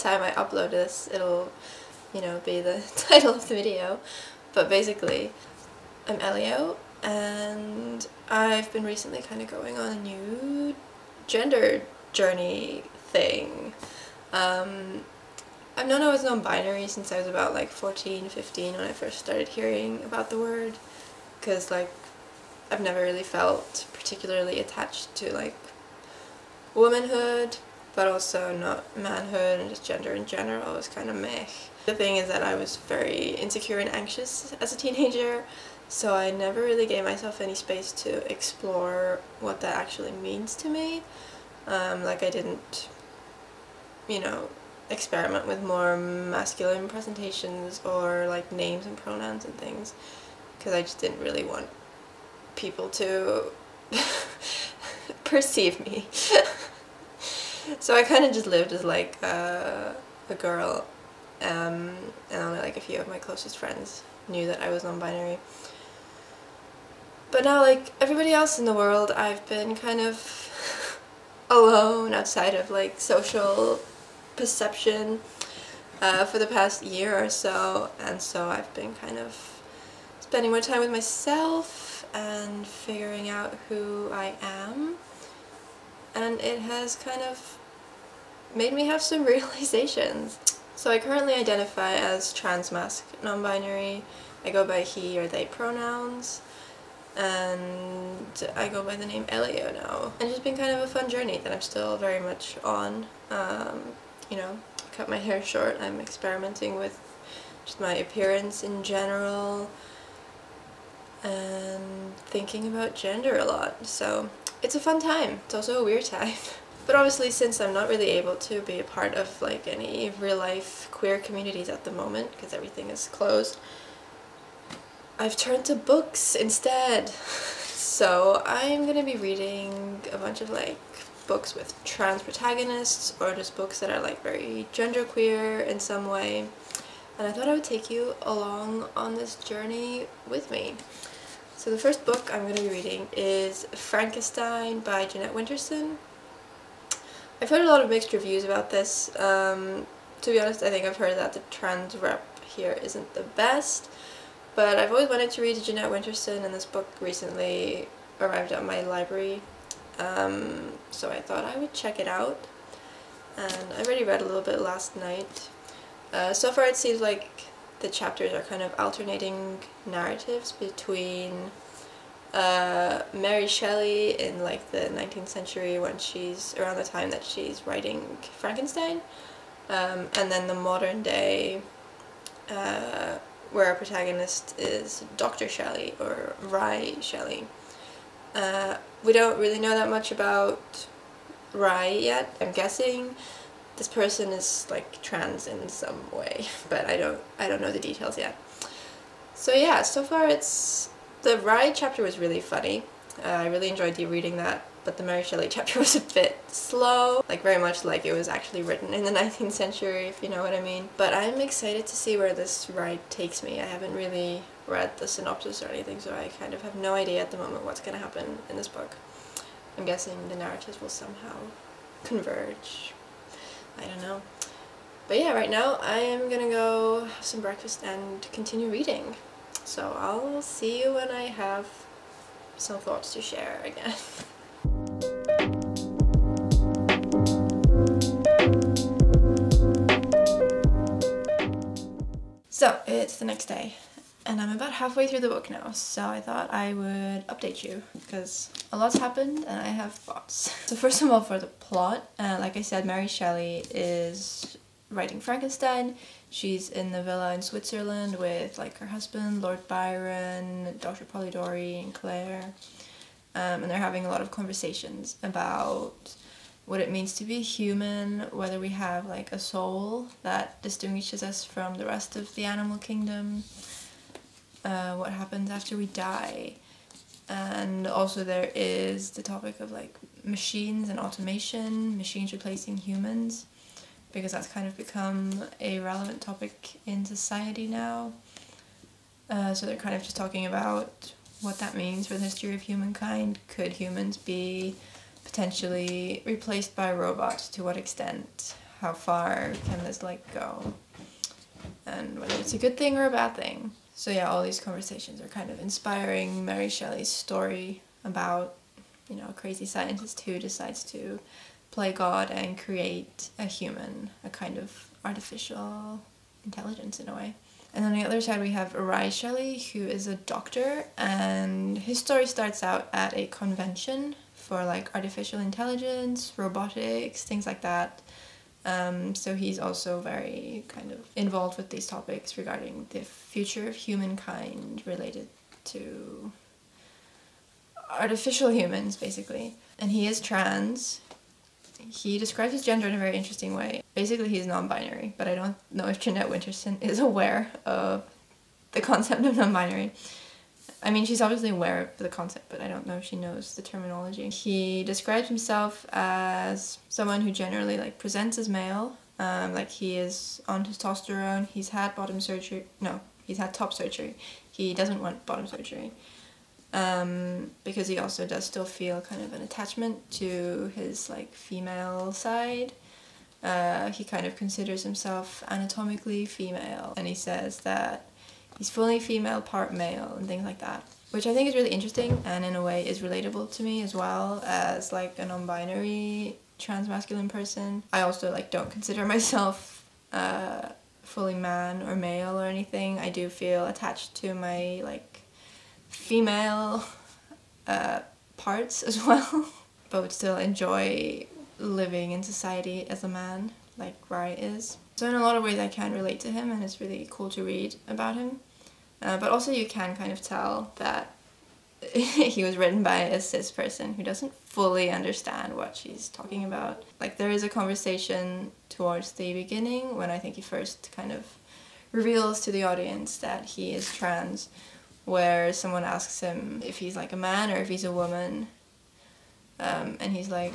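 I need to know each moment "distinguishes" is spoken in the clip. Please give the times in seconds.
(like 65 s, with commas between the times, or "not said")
270 s.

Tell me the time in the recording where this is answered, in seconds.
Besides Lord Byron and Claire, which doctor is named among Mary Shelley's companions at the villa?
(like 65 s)
260 s.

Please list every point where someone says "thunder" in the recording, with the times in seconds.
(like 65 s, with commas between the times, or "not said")
not said.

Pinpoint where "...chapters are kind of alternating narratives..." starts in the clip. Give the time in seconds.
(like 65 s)
167 s.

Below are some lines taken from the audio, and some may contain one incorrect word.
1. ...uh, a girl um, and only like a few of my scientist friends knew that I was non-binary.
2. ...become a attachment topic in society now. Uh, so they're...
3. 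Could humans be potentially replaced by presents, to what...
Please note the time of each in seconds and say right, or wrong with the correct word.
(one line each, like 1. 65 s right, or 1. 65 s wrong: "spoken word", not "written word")
1. 59 s wrong: "closest", not "scientist"
2. 284 s wrong: "relevant", not "attachment"
3. 293 s wrong: "robots", not "presents".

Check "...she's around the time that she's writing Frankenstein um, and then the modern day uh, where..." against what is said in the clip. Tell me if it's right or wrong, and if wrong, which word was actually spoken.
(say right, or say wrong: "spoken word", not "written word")
right.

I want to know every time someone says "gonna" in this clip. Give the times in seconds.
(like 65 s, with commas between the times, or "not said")
128 s, 226 s.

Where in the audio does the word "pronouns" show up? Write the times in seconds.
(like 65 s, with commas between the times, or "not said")
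48 s, 95 s.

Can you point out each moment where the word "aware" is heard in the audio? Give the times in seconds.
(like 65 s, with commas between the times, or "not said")
346 s, 351 s.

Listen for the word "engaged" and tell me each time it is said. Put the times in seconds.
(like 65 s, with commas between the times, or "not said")
not said.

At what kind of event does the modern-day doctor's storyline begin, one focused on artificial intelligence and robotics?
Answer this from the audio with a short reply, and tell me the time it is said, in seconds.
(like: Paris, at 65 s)
A convention, at 323 s.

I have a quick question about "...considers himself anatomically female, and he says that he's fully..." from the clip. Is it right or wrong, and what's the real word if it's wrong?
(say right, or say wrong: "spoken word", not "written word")
right.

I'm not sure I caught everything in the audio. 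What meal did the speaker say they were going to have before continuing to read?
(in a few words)
Breakfast.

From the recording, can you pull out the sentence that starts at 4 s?
But basically, I'm Elio, and I've been recently kind of going on a new gender journey thing.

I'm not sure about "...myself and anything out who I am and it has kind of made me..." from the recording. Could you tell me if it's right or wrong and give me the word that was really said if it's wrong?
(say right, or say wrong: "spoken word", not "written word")
wrong: "figuring", not "anything".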